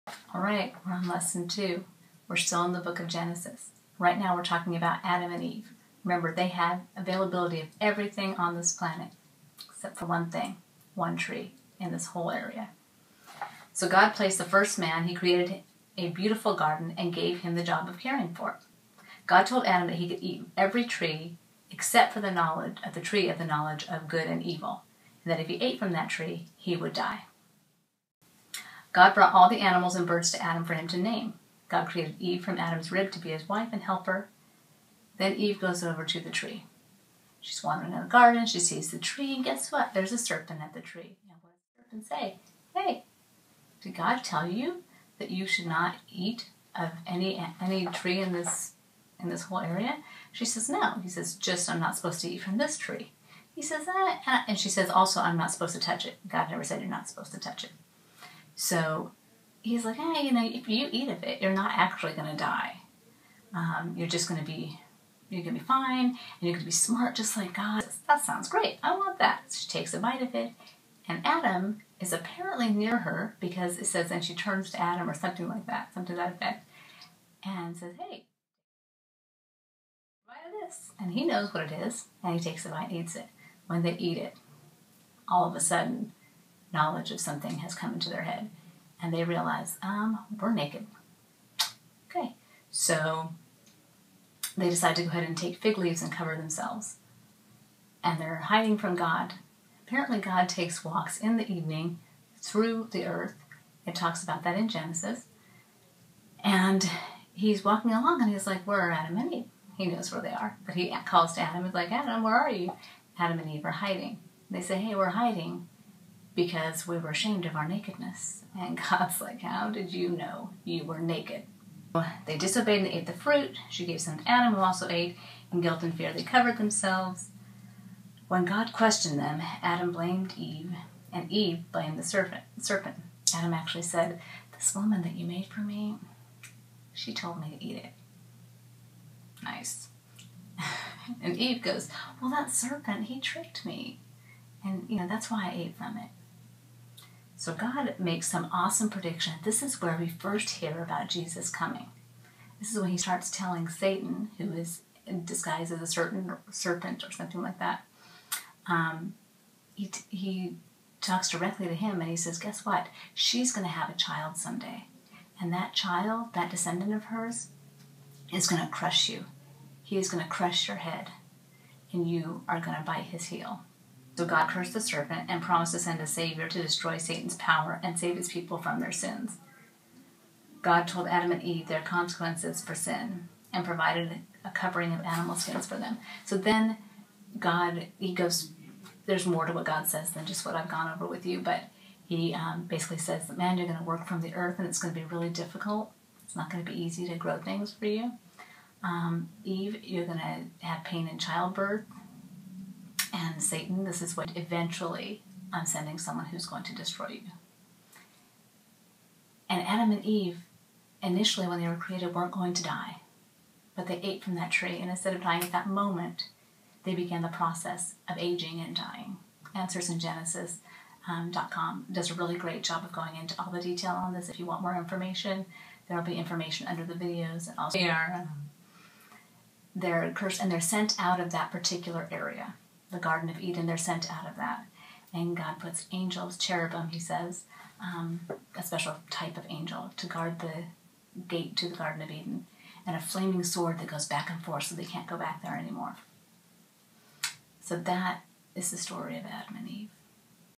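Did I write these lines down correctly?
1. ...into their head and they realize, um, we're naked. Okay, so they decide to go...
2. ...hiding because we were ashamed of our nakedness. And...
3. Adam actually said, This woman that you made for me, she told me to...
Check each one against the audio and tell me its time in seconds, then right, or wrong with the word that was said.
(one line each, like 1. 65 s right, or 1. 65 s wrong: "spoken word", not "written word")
1. 87 s right
2. 115 s right
3. 133 s right.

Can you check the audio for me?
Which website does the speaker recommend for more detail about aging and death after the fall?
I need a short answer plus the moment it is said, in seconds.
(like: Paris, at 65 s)
AnswersInGenesis.com, at 219 s.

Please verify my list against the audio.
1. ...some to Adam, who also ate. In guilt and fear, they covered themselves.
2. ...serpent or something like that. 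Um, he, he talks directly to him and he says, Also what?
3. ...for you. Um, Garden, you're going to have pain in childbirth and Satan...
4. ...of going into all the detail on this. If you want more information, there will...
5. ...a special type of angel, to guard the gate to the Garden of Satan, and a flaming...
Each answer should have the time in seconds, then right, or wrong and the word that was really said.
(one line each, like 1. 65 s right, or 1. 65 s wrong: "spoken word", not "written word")
1. 123 s right
2. 156 s wrong: "Guess", not "Also"
3. 197 s wrong: "Eve", not "Garden"
4. 222 s right
5. 238 s wrong: "Eden", not "Satan".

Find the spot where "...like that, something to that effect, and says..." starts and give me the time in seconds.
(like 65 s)
75 s.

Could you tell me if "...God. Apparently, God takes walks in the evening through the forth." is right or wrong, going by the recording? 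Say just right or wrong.
wrong.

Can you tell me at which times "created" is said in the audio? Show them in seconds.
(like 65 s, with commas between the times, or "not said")
15 s, 31 s, 211 s.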